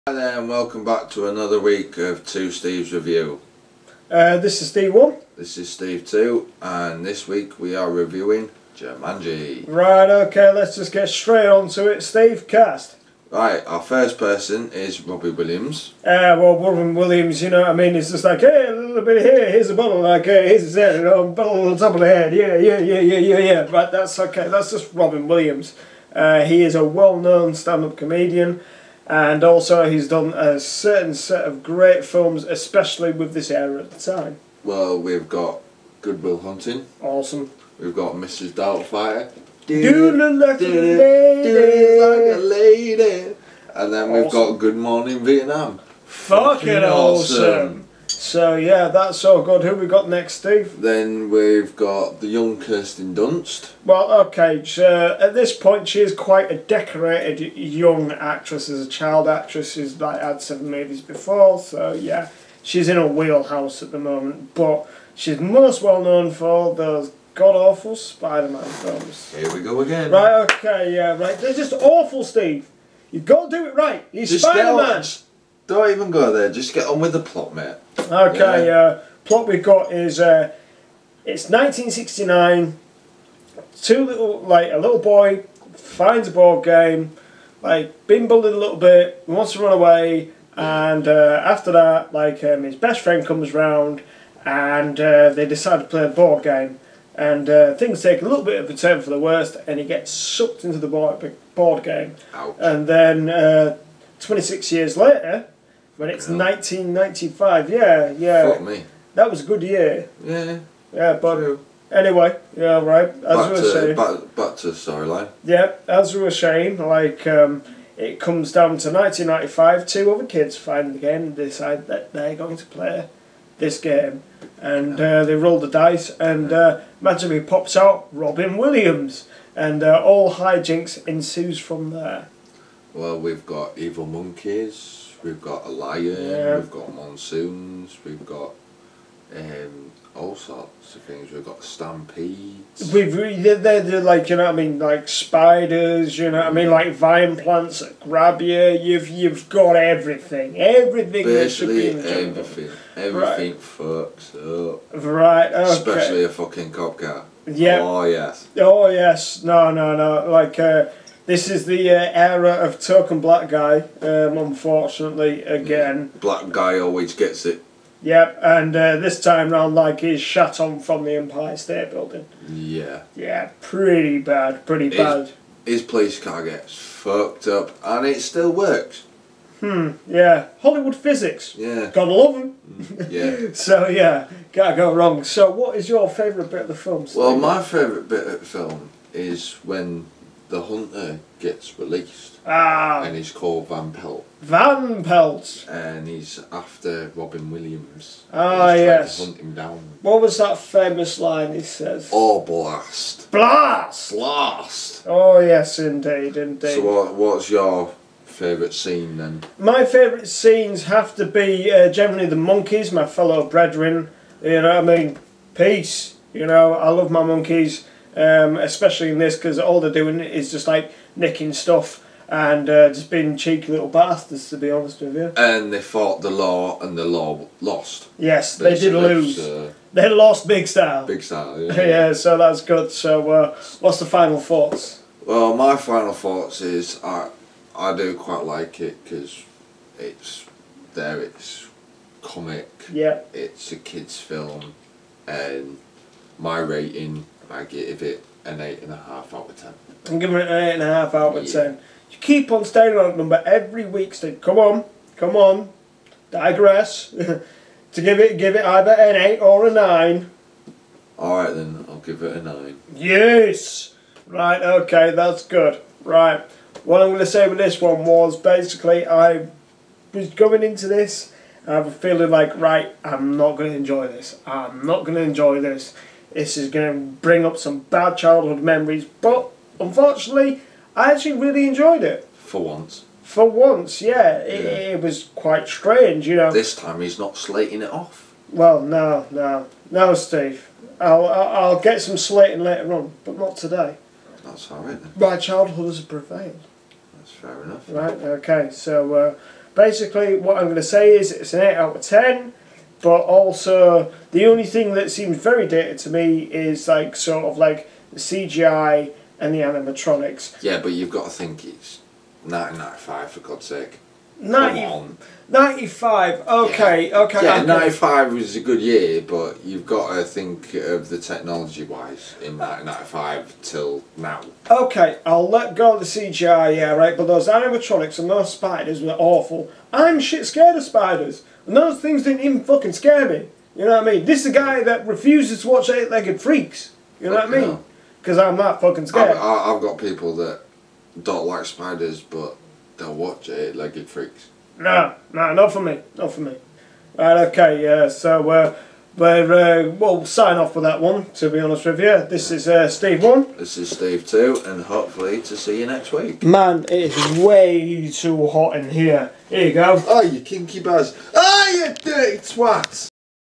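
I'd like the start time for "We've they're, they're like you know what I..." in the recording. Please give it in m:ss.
2:22.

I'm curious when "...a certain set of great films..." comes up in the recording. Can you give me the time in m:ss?
0:30.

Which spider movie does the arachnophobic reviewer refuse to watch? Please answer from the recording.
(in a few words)
Eight Legged Freaks.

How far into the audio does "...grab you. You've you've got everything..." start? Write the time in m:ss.
2:28.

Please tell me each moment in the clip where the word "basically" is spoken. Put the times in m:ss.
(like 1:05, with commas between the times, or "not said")
2:31, 4:28, 4:59.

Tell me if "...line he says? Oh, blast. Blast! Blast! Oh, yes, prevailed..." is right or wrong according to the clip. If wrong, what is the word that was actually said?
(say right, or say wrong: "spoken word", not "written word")
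wrong: "indeed", not "prevailed".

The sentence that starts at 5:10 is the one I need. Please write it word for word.
Yeah, but you've got to think it's 1995 for God's sake.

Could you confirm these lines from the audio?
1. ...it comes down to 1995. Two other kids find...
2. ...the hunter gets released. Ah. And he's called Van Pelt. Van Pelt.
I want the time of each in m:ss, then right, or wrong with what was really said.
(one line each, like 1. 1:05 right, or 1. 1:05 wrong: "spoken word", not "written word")
1. 1:57 right
2. 3:10 right.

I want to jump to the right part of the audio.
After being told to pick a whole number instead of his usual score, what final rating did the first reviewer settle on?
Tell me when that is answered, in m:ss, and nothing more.
4:21.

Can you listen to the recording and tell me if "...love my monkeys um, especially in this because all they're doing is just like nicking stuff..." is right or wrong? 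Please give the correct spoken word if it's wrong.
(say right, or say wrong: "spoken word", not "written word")
right.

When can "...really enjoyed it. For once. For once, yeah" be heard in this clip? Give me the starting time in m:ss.
4:41.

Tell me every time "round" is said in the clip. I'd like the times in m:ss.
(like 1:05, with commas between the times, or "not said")
1:33, 2:49.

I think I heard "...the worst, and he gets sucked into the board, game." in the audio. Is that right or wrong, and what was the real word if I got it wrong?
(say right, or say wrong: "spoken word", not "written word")
right.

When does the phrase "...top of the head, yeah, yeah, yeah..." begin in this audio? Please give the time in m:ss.
0:21.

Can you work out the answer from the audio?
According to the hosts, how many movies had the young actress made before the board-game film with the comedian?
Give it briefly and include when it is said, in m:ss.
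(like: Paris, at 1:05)
7, at 1:00.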